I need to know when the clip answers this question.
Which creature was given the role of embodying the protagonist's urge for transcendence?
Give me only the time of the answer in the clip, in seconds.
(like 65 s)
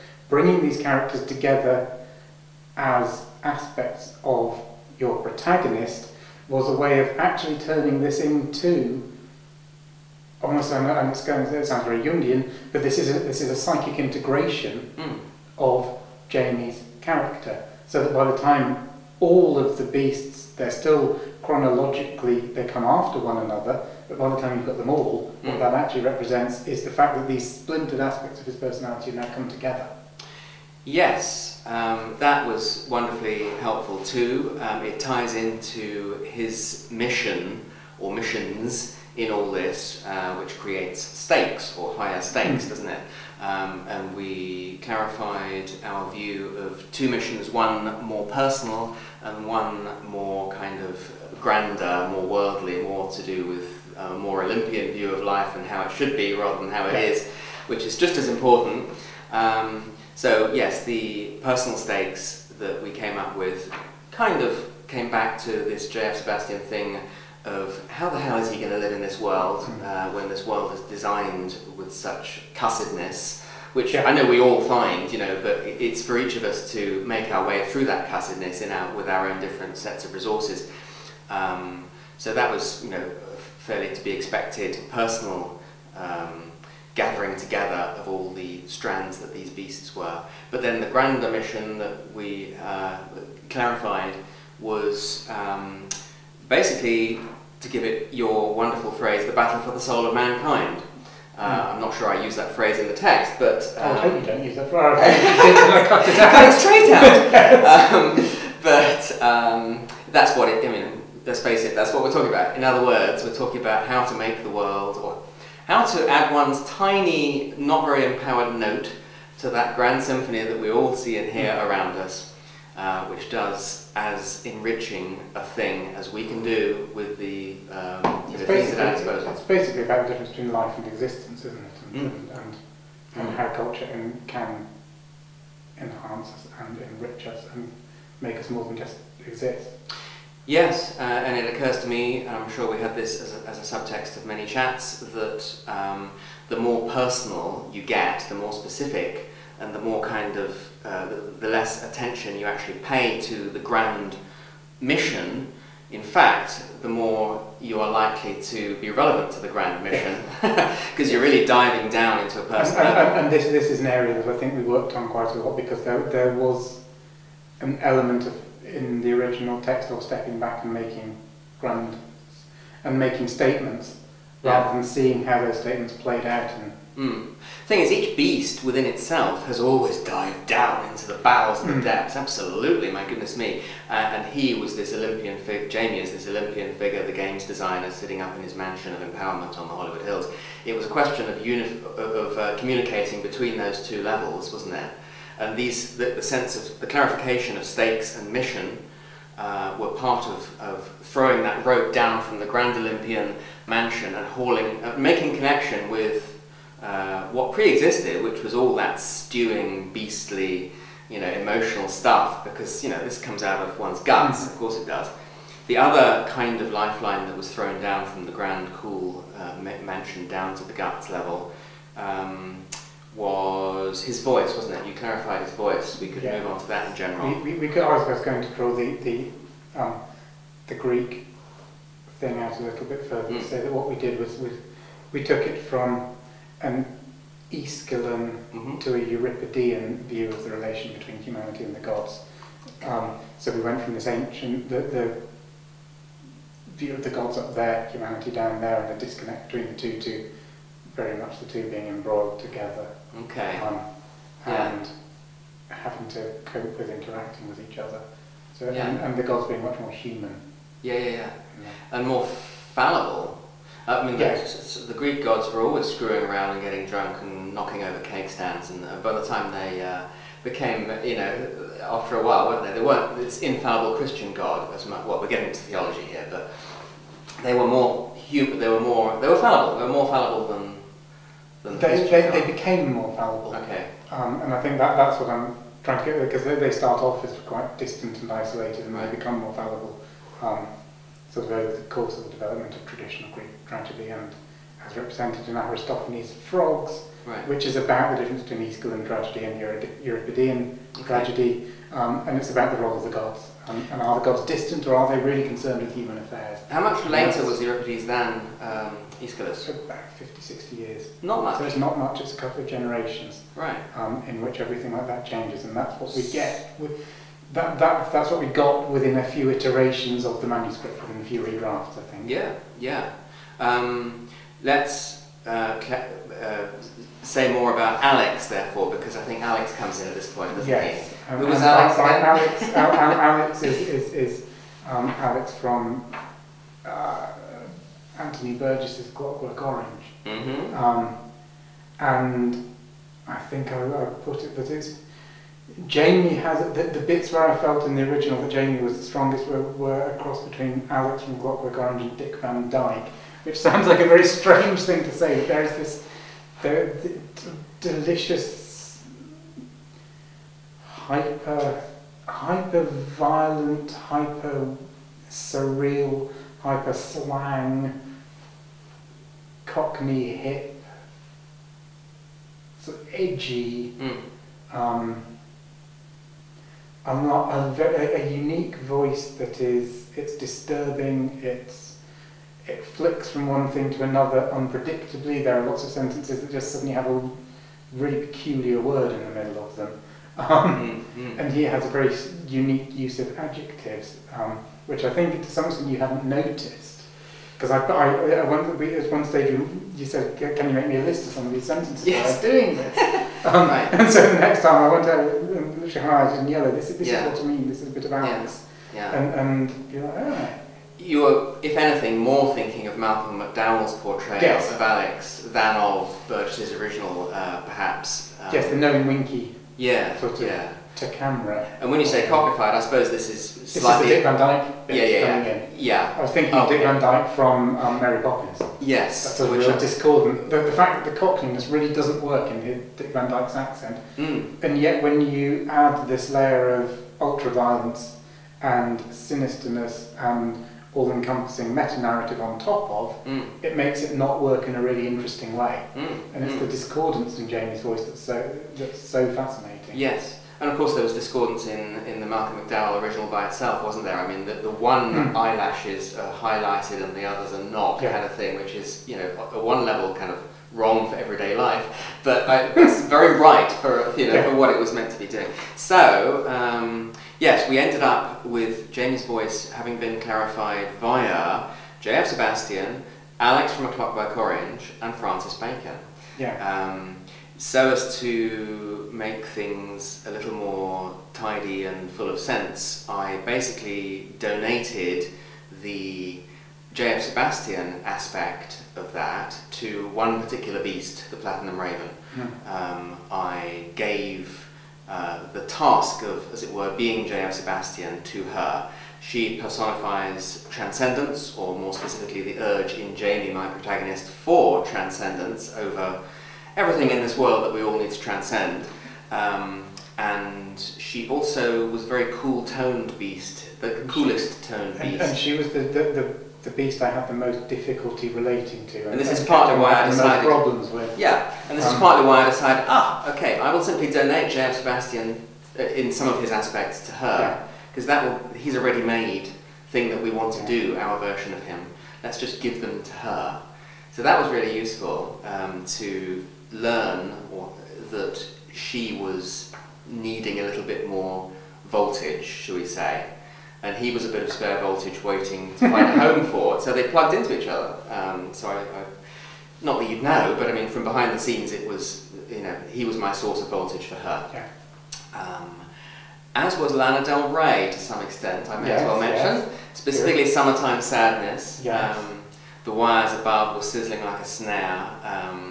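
491 s.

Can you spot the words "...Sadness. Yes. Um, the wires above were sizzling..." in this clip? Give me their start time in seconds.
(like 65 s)
561 s.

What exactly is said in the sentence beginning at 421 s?
And when you say cockified, I suppose this is slightly.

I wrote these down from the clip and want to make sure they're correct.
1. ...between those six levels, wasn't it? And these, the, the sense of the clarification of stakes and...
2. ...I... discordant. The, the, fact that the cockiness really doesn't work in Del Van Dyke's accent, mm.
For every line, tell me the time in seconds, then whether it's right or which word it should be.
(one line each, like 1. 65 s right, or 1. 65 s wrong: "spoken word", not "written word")
1. 193 s wrong: "two", not "six"
2. 429 s wrong: "Dick", not "Del".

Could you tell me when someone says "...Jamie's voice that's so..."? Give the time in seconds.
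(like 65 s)
447 s.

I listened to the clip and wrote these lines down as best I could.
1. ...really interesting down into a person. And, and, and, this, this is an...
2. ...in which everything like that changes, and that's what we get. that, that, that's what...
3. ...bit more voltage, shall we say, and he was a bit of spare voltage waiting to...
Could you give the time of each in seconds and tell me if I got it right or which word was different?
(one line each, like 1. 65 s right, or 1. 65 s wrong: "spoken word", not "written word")
1. 161 s wrong: "diving", not "interesting"
2. 314 s right
3. 540 s right.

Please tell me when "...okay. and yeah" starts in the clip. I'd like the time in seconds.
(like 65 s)
253 s.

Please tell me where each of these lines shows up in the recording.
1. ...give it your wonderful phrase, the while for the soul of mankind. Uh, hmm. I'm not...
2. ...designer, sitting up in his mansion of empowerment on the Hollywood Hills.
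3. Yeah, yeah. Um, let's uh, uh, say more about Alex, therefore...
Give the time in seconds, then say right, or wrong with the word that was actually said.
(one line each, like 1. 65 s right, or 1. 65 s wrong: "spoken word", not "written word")
1. 97 s wrong: "battle", not "while"
2. 187 s right
3. 322 s right.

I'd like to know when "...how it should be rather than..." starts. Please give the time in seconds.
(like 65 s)
55 s.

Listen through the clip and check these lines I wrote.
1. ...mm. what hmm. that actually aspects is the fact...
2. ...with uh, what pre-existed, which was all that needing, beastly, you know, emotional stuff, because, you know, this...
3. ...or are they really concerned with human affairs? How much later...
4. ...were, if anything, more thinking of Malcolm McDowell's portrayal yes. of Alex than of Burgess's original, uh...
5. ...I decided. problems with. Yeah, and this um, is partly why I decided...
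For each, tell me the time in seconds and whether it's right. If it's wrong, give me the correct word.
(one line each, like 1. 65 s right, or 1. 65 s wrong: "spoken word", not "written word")
1. 25 s wrong: "represents", not "aspects"
2. 205 s wrong: "stewing", not "needing"
3. 304 s right
4. 411 s right
5. 519 s right.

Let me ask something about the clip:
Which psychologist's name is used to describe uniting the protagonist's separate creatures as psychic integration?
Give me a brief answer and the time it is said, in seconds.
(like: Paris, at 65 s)
Jungian, at 12 s.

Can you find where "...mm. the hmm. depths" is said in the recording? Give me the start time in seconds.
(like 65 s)
181 s.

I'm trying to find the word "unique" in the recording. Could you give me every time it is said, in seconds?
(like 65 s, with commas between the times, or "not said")
378 s, 392 s.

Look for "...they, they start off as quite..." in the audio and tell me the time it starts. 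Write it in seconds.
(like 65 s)
286 s.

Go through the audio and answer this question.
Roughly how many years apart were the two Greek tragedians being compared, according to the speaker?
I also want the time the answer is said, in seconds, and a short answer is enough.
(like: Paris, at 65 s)
50 to 60 years, at 310 s.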